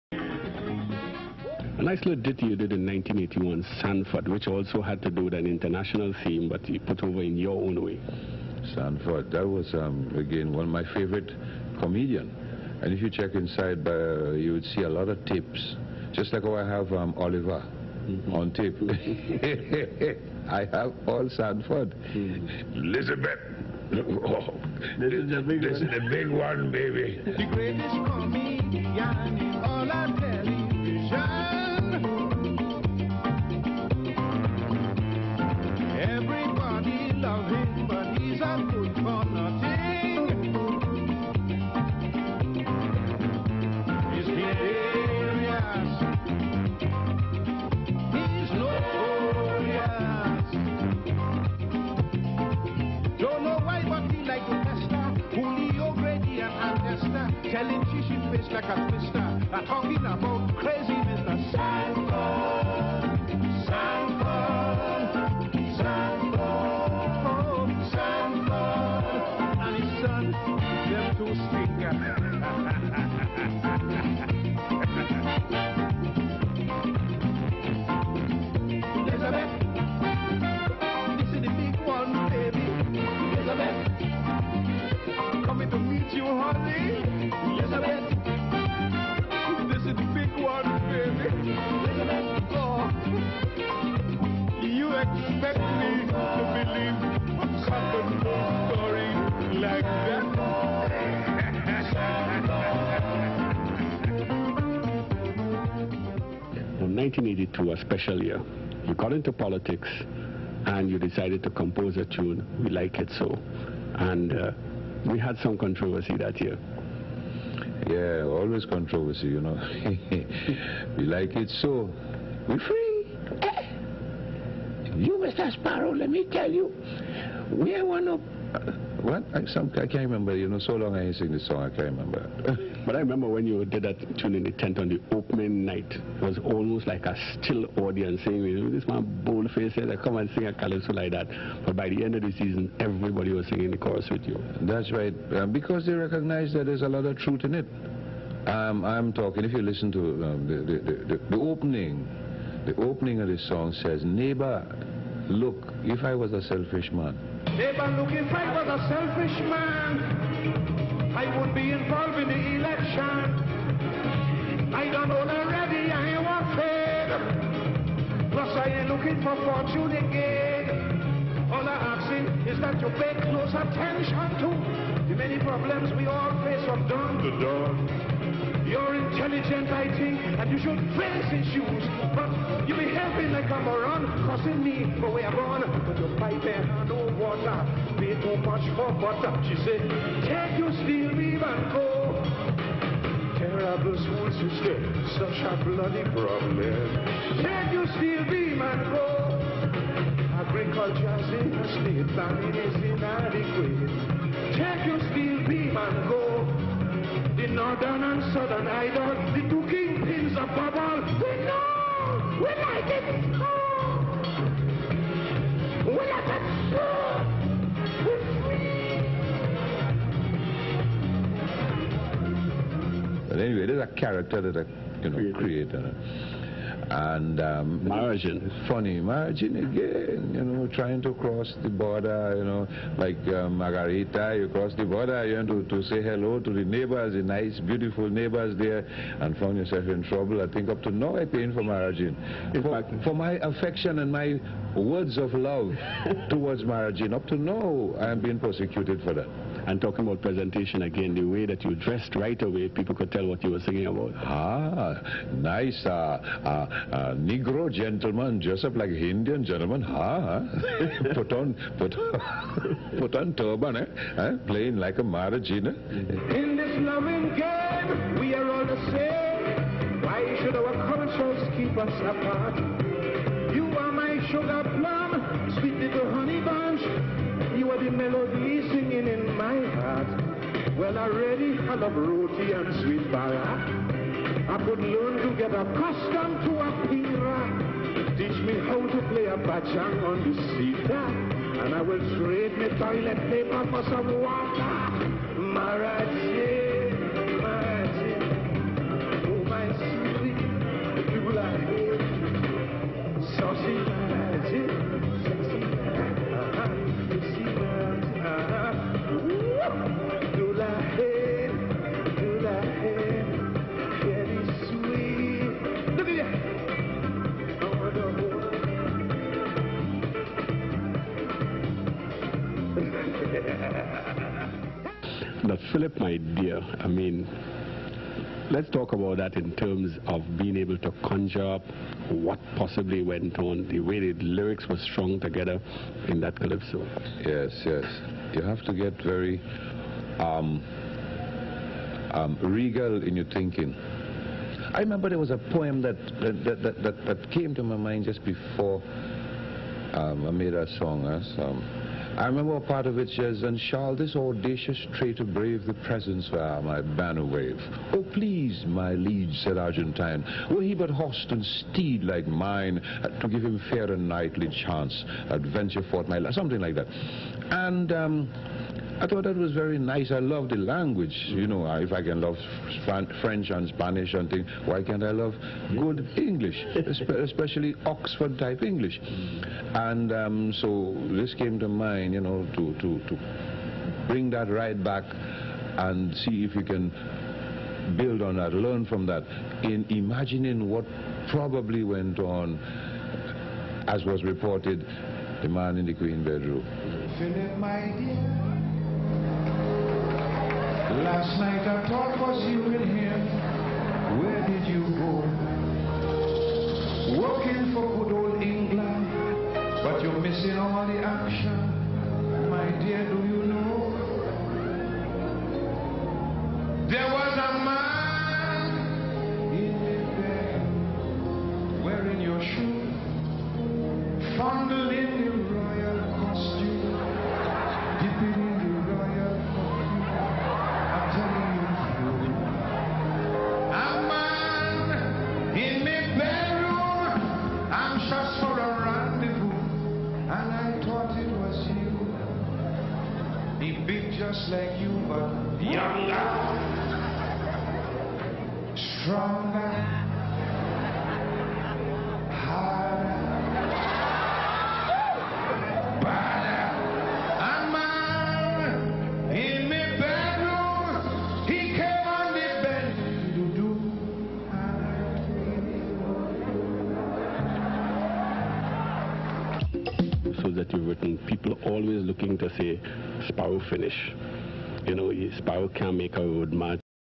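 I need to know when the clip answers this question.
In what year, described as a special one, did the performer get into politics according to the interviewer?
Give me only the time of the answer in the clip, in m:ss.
1:46.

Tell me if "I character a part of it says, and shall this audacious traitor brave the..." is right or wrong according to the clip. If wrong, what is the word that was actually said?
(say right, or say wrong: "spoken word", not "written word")
wrong: "remember", not "character".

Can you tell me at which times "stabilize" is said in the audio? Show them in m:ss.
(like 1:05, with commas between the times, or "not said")
not said.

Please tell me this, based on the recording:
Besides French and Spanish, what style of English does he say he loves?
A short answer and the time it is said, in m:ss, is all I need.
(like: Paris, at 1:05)
Oxford type English, at 6:17.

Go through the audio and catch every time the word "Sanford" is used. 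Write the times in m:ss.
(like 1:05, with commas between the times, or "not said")
0:03, 0:08, 0:21.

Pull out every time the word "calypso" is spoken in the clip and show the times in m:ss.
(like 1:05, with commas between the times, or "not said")
2:20, 5:36.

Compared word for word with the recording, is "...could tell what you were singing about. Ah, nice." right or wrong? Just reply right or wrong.
right.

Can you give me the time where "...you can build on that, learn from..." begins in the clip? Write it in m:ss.
6:26.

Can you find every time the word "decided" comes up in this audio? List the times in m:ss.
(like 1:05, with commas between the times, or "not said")
1:50.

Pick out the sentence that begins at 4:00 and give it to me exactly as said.
I think up to now I paying for margin.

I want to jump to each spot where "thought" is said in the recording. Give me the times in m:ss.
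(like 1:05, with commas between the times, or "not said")
6:09, 6:41.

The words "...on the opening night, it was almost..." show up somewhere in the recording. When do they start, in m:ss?
2:14.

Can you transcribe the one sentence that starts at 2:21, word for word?
But by the end of the season, everybody was singing the chorus with you.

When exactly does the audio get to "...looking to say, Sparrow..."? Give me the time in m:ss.
7:52.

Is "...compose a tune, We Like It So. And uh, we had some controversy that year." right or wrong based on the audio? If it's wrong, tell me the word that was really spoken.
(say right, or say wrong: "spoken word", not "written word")
right.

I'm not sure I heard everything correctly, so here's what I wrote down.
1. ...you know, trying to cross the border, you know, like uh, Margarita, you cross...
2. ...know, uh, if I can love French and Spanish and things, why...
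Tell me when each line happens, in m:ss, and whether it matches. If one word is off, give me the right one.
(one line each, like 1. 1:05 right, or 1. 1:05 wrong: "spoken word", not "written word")
1. 3:50 right
2. 6:11 right.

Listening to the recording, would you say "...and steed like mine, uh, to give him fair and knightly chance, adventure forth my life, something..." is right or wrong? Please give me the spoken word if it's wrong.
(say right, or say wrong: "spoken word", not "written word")
right.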